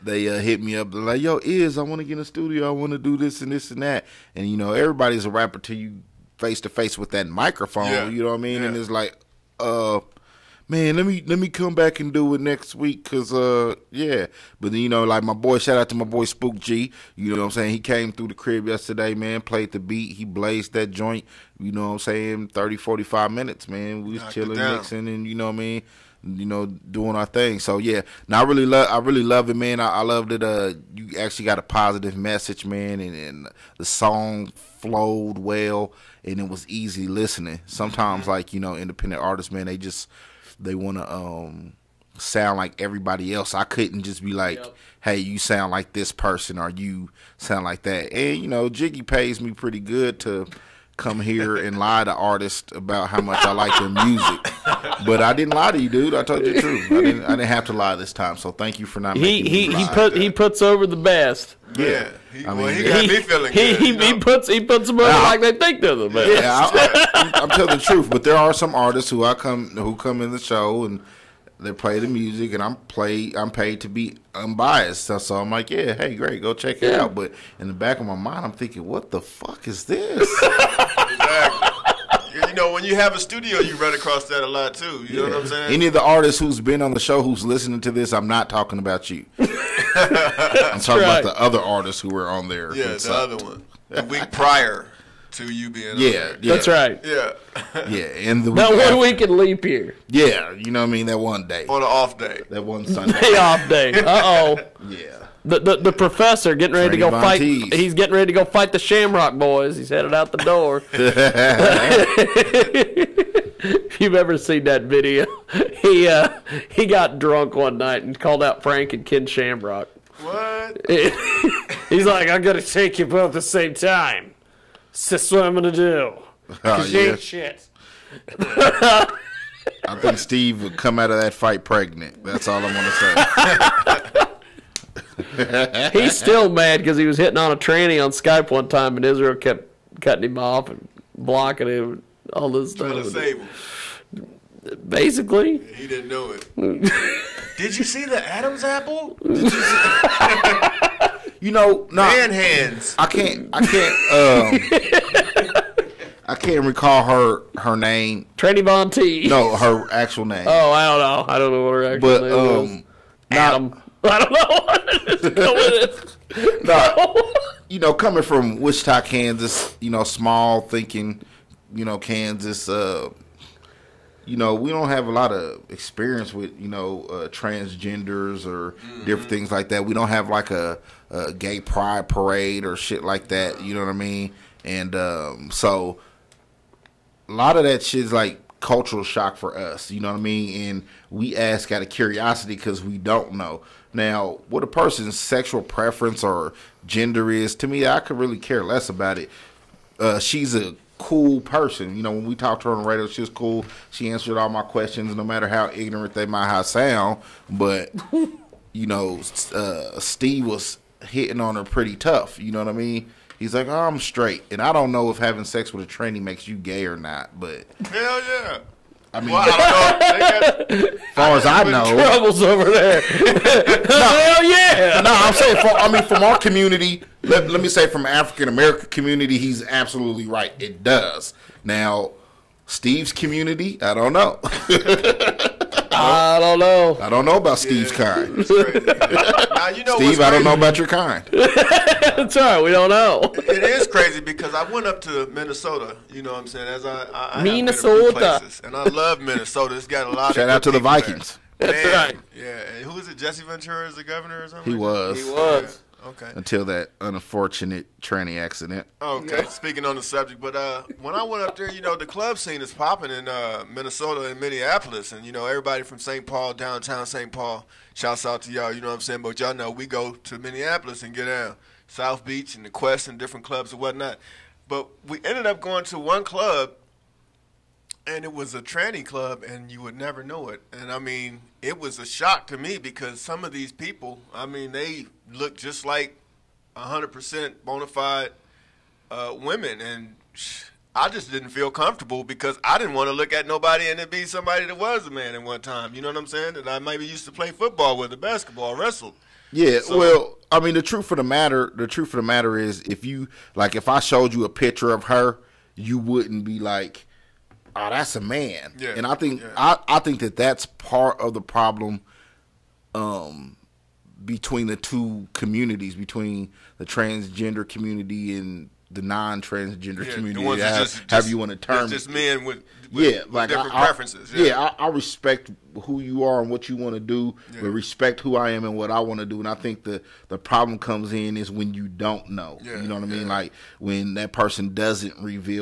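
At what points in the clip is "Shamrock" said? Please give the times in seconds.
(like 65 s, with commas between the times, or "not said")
108 s, 119 s.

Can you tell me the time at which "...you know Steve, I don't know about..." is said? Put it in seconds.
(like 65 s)
239 s.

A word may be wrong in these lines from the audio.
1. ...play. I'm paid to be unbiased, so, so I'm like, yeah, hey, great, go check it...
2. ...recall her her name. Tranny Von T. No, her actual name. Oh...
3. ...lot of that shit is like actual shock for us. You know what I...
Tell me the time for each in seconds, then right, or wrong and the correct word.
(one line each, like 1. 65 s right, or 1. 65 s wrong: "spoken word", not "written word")
1. 72 s right
2. 156 s right
3. 187 s wrong: "cultural", not "actual".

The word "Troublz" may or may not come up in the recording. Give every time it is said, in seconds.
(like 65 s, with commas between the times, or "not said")
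221 s.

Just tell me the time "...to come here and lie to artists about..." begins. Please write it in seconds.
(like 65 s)
50 s.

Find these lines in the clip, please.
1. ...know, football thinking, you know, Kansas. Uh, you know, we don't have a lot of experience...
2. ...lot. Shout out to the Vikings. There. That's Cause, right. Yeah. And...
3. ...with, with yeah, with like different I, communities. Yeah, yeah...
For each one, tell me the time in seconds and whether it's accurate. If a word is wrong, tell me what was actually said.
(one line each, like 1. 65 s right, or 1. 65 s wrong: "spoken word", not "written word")
1. 169 s wrong: "small", not "football"
2. 250 s wrong: "Man", not "Cause"
3. 322 s wrong: "preferences", not "communities".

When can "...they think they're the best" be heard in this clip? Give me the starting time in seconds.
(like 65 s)
65 s.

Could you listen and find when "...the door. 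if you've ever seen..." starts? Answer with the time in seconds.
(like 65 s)
110 s.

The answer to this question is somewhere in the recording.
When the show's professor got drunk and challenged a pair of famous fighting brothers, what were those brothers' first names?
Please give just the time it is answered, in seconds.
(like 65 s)
118 s.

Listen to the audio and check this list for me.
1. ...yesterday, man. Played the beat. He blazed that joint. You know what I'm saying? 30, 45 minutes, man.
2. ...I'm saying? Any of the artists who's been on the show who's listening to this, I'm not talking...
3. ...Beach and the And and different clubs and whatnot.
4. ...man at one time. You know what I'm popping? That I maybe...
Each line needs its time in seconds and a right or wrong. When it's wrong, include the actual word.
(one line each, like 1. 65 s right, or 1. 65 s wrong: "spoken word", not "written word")
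1. 18 s right
2. 85 s right
3. 272 s wrong: "Quest", not "And"
4. 295 s wrong: "saying", not "popping".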